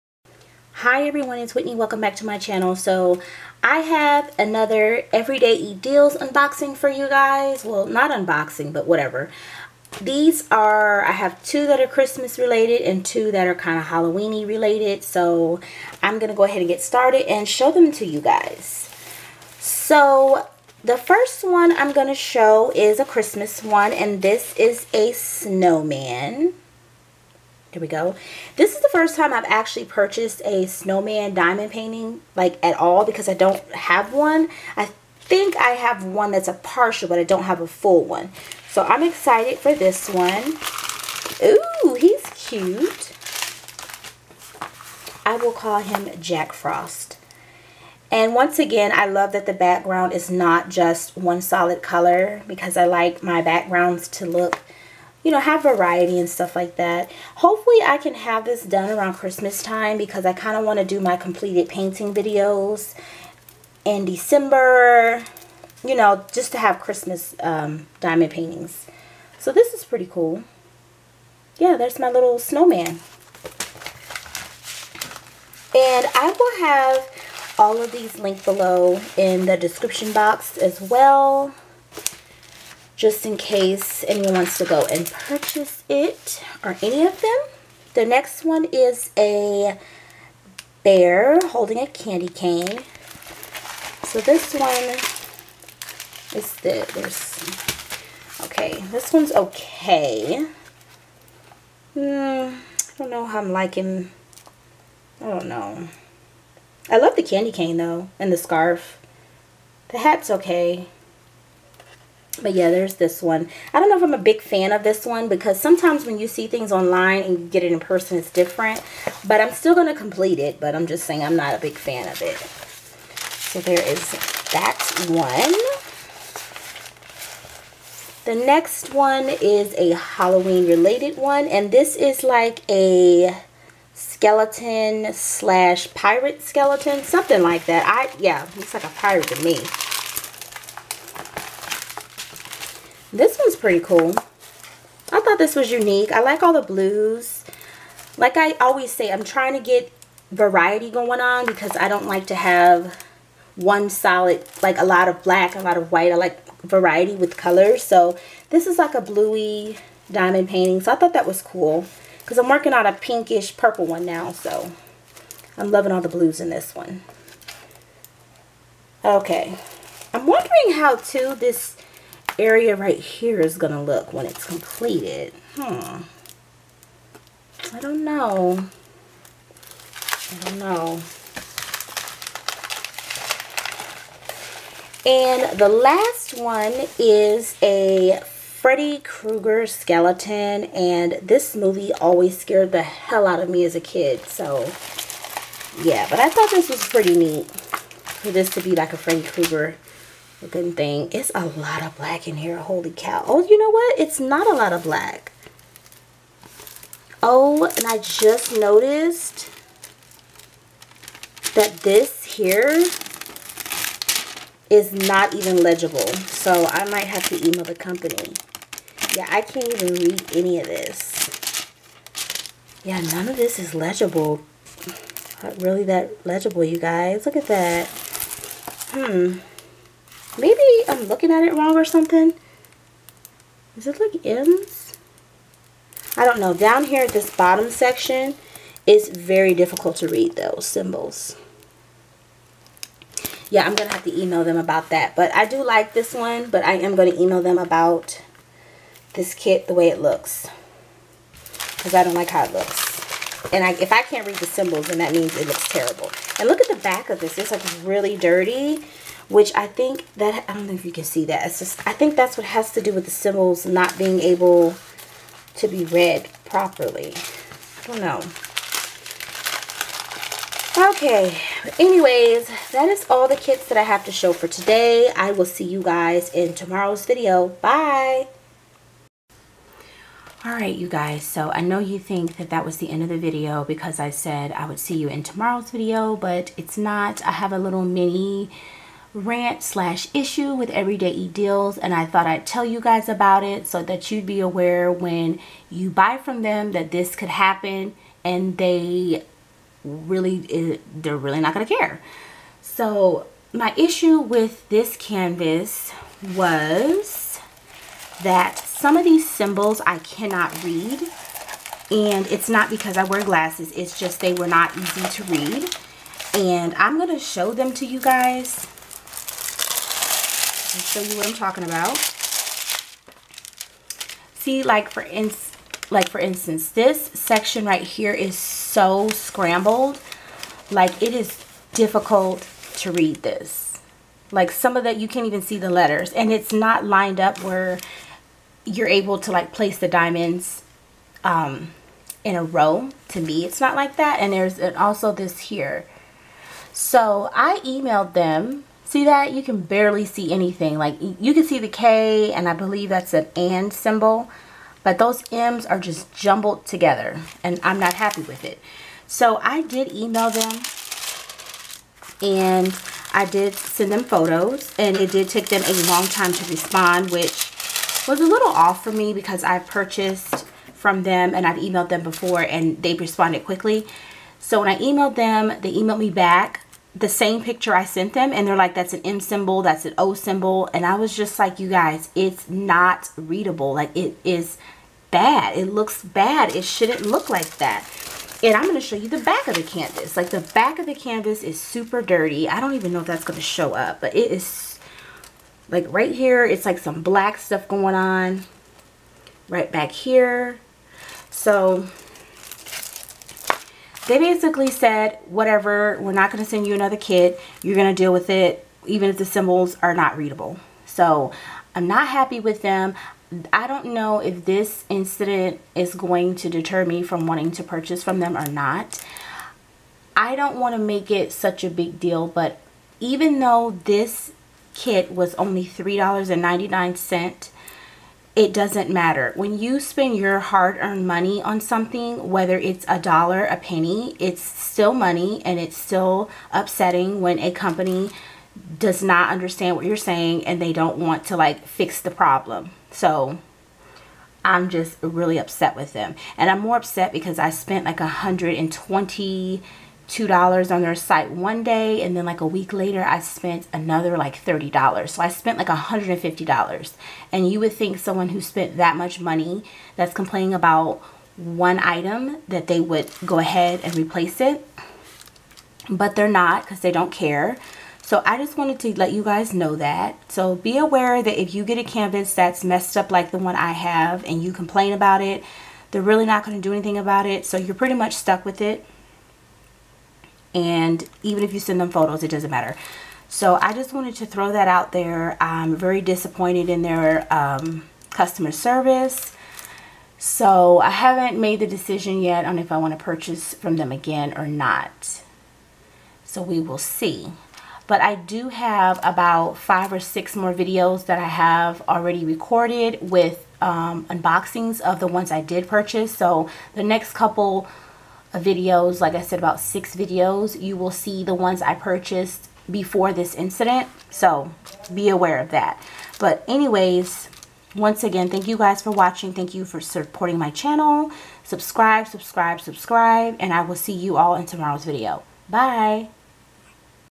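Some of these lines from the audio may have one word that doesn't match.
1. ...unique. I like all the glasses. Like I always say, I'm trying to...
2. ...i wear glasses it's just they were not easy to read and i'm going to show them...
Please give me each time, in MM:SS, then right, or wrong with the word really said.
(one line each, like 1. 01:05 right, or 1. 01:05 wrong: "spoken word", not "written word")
1. 02:25 wrong: "blues", not "glasses"
2. 05:12 right.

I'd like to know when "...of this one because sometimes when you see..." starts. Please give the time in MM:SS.
01:54.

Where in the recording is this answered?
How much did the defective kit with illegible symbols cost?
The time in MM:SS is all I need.
07:05.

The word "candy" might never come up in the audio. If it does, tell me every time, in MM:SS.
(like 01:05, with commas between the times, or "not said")
01:31, 01:47.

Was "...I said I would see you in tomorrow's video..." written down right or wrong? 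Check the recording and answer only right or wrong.
right.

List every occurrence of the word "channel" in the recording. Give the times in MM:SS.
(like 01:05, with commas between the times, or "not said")
00:02, 08:40.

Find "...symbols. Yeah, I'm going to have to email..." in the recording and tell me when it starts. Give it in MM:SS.
04:00.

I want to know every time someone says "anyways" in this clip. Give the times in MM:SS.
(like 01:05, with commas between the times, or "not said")
04:31, 08:36.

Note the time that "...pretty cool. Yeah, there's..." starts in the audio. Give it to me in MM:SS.
01:09.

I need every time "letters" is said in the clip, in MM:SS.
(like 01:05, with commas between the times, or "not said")
05:35.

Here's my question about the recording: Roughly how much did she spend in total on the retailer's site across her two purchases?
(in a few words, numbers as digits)
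$150.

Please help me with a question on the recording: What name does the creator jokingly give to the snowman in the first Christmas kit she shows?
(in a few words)
Jack Frost.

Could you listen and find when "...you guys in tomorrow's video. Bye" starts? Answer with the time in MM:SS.
04:35.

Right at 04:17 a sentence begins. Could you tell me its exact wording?
It's like really dirty which I think that, I don't know if you can see that.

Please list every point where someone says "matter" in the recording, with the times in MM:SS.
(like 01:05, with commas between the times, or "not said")
07:08, 08:02.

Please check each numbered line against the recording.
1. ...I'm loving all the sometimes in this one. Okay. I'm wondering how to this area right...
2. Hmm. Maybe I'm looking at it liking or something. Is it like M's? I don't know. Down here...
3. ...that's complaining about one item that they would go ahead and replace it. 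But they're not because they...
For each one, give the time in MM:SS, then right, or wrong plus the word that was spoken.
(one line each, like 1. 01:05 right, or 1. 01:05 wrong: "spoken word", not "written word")
1. 02:45 wrong: "blues", not "sometimes"
2. 03:48 wrong: "wrong", not "liking"
3. 07:39 right.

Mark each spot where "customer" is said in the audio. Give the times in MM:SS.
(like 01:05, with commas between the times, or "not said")
08:08.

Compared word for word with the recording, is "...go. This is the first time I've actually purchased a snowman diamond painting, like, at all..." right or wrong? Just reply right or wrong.
right.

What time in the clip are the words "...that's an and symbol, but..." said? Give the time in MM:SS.
05:52.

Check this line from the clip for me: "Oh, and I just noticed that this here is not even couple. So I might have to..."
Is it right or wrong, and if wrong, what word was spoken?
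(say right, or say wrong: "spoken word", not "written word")
wrong: "legible", not "couple".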